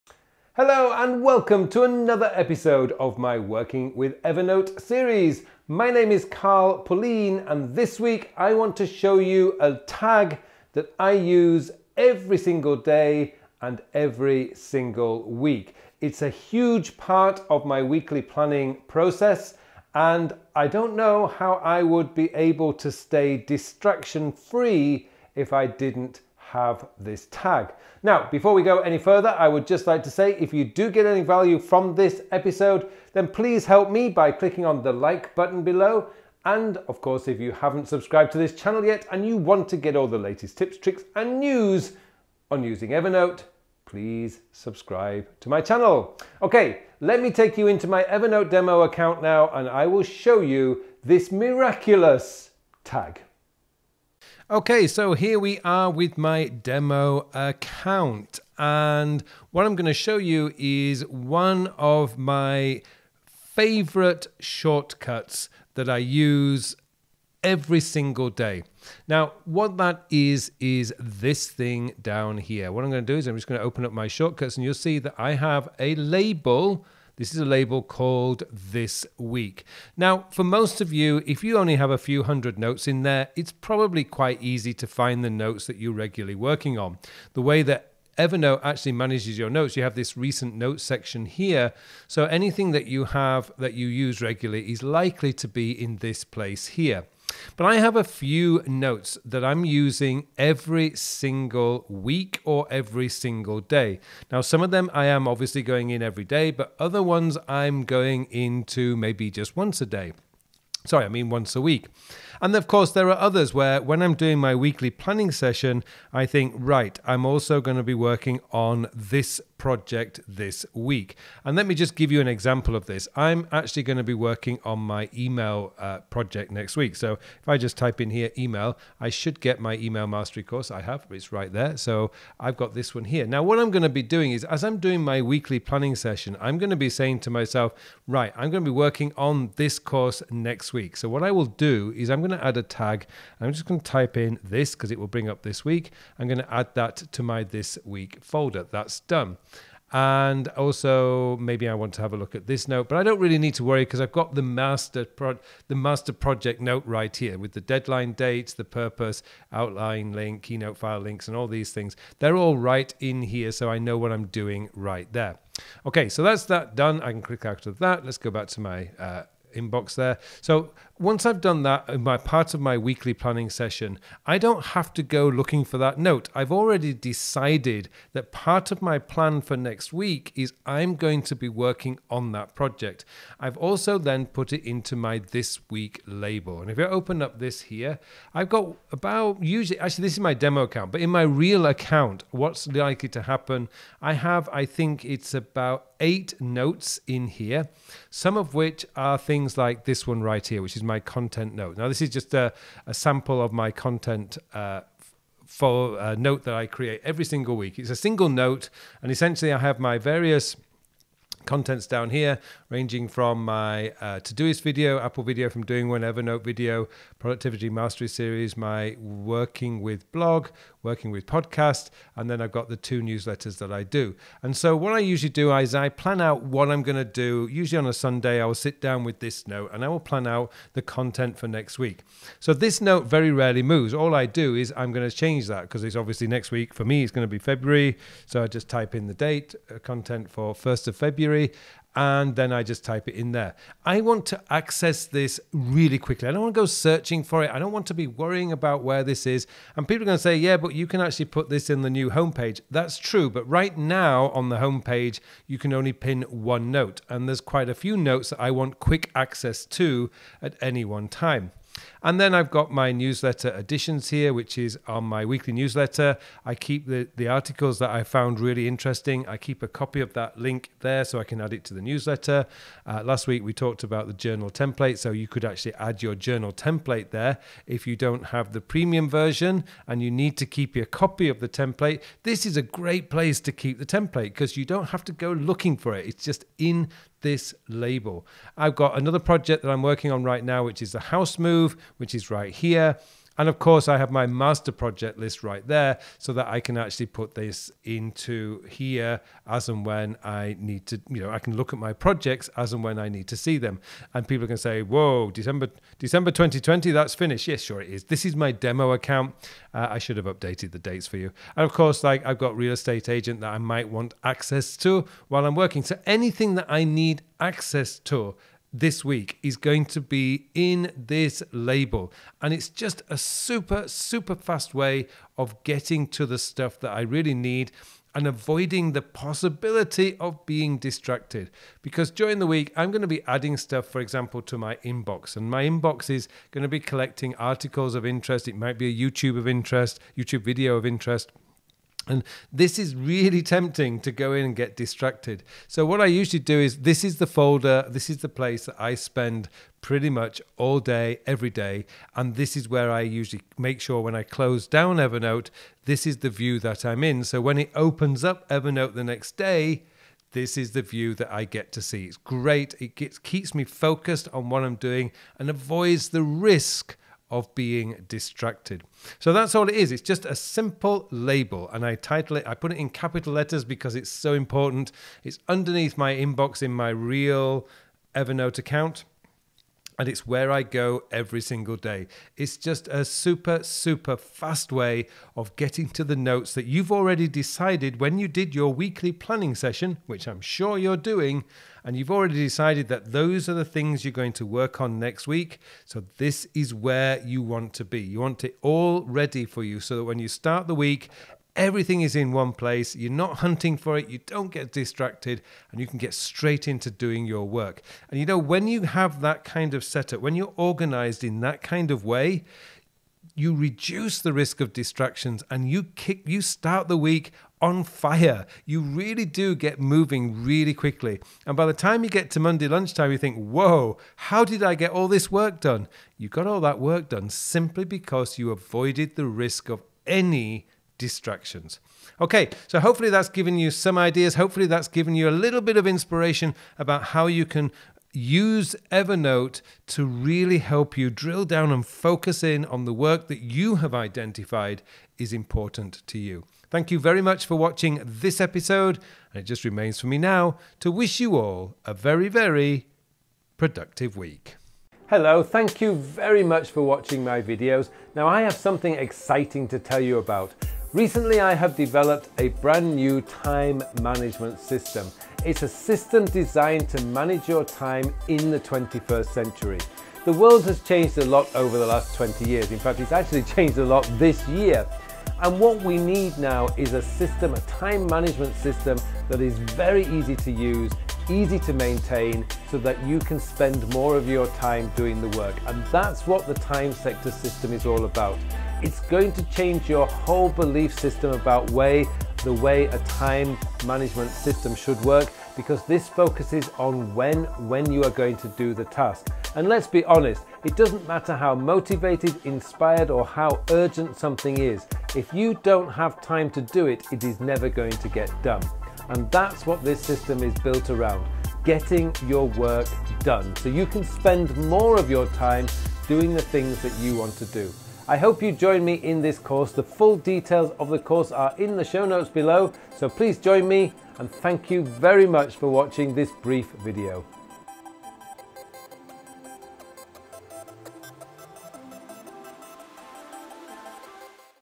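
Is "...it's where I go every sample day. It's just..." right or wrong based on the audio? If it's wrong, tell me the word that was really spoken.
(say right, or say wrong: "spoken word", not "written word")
wrong: "single", not "sample".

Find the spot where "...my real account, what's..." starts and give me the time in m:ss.
3:11.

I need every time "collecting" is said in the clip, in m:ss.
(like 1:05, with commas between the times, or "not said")
5:36.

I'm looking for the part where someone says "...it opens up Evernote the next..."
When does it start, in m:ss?
5:57.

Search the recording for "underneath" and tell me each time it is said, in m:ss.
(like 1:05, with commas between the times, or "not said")
6:15.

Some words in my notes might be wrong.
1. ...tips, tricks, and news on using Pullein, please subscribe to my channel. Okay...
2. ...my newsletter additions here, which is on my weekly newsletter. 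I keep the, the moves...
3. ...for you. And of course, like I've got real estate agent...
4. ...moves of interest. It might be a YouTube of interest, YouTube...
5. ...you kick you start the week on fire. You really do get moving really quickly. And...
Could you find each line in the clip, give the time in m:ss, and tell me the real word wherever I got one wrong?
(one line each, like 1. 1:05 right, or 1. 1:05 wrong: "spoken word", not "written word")
1. 0:40 wrong: "Evernote", not "Pullein"
2. 4:22 wrong: "articles", not "moves"
3. 5:11 right
4. 5:37 wrong: "articles", not "moves"
5. 6:55 right.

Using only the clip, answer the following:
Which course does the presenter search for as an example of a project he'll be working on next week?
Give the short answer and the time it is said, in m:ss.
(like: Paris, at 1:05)
Email Mastery course, at 2:09.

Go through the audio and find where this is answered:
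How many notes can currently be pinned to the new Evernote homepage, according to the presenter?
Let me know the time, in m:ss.
4:16.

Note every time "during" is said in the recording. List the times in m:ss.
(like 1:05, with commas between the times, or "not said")
5:32.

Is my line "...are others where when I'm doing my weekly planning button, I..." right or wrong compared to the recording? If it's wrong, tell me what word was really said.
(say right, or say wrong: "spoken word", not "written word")
wrong: "session", not "button".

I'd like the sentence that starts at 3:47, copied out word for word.
Usually on a Sunday, I will sit down with this note and I will plan out the content for next week.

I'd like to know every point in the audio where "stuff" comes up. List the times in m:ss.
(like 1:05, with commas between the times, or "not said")
5:26, 5:33.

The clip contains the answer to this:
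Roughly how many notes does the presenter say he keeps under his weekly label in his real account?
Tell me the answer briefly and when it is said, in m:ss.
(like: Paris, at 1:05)
8, at 3:15.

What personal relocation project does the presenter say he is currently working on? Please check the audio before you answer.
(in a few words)
The house move.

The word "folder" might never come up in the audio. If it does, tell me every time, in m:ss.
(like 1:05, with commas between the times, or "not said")
2:28, 5:47.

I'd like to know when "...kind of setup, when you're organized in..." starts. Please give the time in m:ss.
6:49.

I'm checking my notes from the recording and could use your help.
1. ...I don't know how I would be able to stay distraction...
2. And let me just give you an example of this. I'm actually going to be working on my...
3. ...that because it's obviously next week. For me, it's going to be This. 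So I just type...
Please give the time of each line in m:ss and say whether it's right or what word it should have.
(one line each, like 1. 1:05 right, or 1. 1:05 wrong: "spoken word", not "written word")
1. 0:20 right
2. 2:01 right
3. 3:55 wrong: "February", not "This".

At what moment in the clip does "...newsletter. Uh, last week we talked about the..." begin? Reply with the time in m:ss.
4:31.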